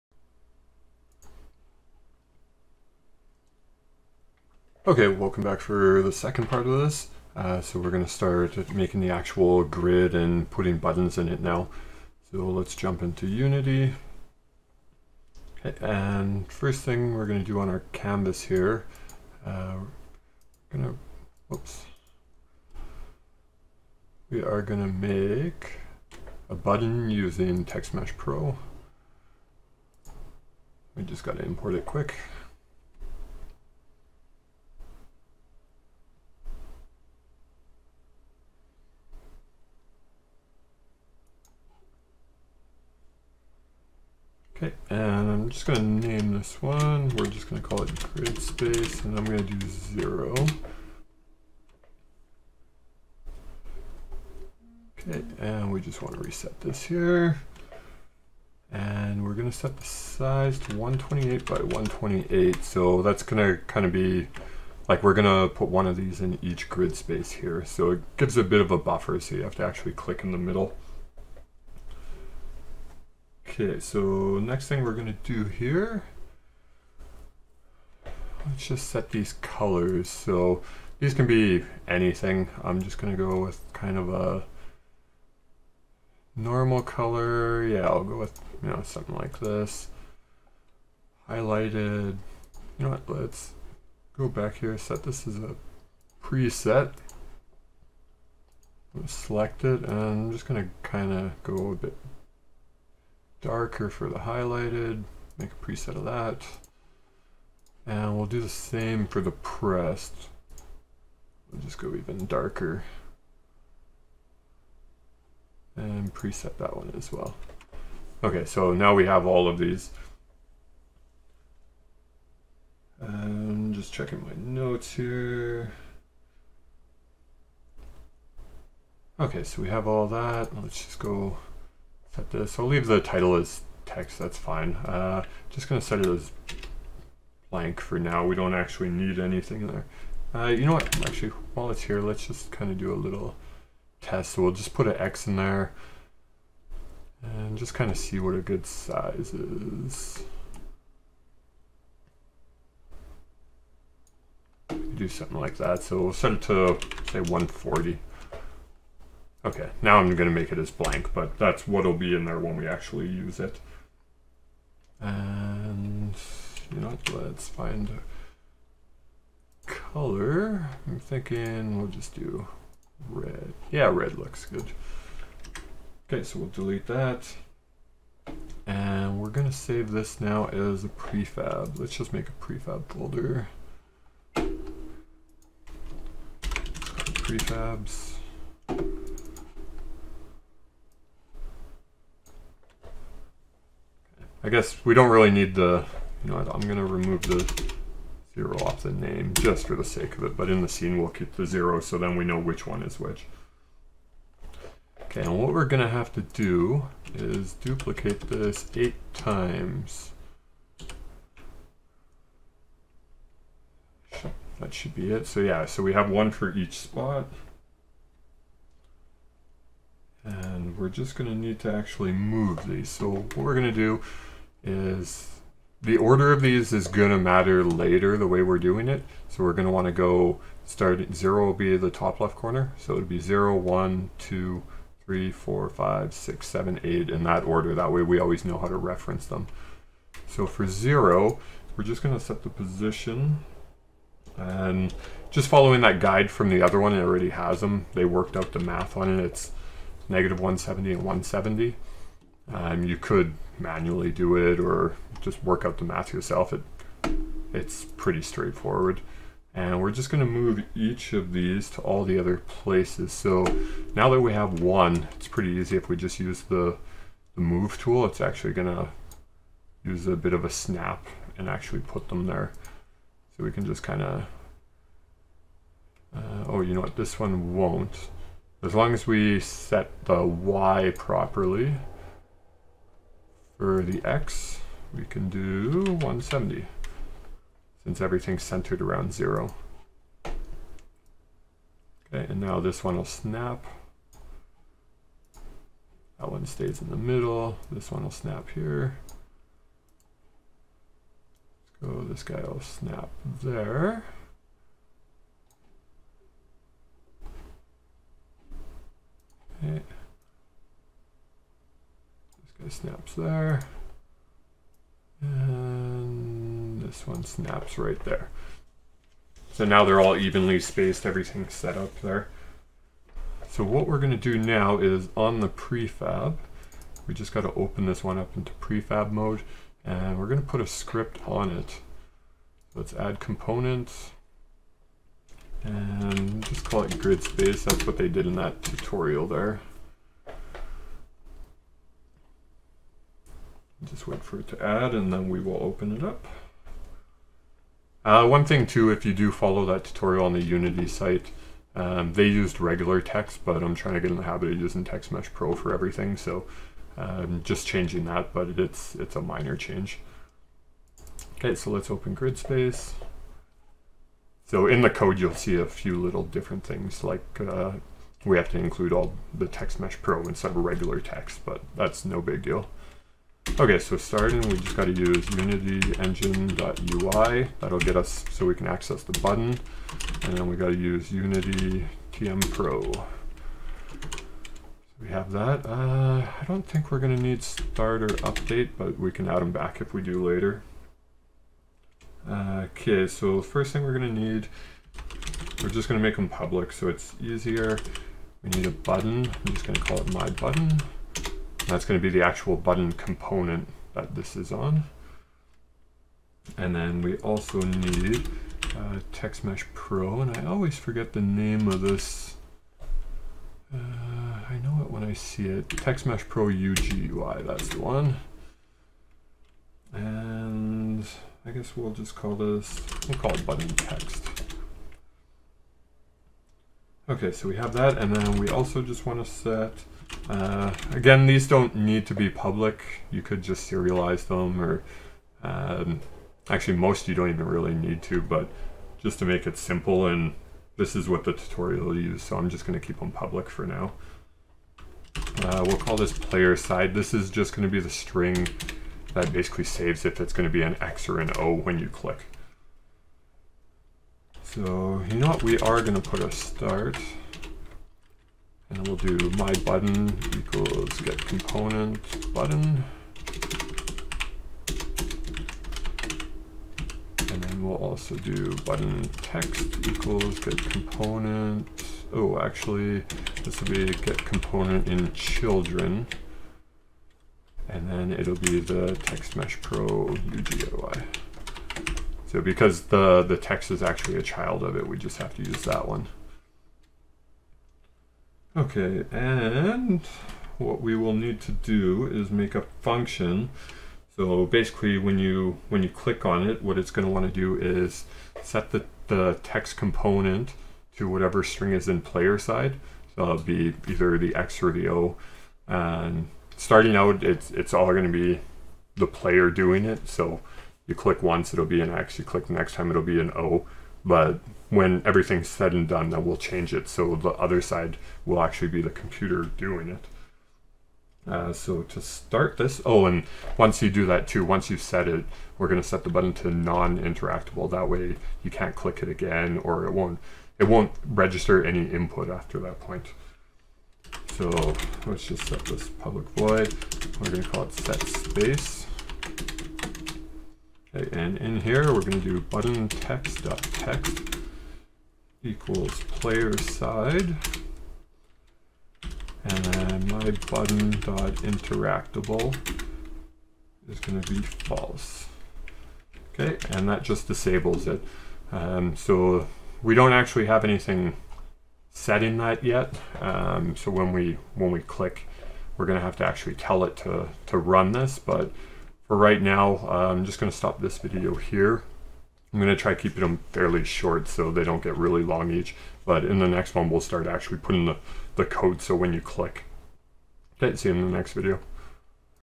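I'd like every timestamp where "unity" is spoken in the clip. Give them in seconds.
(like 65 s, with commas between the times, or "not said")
13 s, 350 s, 375 s, 381 s.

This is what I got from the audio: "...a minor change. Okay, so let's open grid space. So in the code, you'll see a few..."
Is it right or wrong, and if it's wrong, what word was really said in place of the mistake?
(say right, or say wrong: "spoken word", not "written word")
right.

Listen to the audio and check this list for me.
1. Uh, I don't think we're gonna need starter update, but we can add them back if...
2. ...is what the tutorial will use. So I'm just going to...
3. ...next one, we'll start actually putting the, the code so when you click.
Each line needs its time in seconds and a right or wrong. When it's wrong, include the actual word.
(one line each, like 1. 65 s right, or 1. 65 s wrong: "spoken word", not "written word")
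1. 385 s right
2. 440 s right
3. 576 s right.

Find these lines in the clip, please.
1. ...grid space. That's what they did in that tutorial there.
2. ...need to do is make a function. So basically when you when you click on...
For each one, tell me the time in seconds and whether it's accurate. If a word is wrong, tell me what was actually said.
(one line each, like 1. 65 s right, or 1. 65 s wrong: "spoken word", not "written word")
1. 336 s right
2. 491 s right.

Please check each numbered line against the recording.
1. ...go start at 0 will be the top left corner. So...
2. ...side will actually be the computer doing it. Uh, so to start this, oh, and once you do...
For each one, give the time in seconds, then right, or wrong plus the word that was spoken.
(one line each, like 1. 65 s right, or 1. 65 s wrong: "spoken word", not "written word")
1. 229 s right
2. 517 s right.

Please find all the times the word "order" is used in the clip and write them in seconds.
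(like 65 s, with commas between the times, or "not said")
225 s, 237 s.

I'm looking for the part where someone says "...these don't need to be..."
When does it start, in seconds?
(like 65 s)
431 s.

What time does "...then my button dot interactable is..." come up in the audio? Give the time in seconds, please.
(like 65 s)
549 s.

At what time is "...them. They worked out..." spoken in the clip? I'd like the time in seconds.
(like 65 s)
247 s.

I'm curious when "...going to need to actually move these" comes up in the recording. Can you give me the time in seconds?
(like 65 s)
221 s.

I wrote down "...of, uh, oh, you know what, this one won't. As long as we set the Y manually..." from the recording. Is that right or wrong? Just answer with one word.
wrong.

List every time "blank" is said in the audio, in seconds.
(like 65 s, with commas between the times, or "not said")
137 s, 160 s.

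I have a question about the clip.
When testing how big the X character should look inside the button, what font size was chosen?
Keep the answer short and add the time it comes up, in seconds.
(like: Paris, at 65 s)
140, at 157 s.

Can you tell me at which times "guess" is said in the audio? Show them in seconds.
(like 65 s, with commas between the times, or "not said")
194 s, 421 s.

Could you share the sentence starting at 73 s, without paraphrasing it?
Okay, so next thing we're gonna do here, let's just set these colors.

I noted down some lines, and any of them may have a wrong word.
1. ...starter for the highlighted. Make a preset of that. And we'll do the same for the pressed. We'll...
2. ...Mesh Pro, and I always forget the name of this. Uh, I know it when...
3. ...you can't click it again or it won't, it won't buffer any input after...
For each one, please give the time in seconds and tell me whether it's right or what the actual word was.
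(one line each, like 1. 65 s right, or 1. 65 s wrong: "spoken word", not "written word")
1. 103 s wrong: "darker", not "starter"
2. 409 s right
3. 528 s wrong: "register", not "buffer".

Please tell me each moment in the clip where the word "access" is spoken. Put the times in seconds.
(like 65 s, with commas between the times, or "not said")
378 s.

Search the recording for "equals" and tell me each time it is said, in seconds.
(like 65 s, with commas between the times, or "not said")
460 s, 469 s, 545 s.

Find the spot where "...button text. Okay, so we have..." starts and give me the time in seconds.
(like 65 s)
423 s.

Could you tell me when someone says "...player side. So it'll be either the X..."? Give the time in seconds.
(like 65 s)
502 s.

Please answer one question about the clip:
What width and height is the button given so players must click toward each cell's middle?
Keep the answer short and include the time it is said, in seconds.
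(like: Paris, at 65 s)
128 by 128, at 60 s.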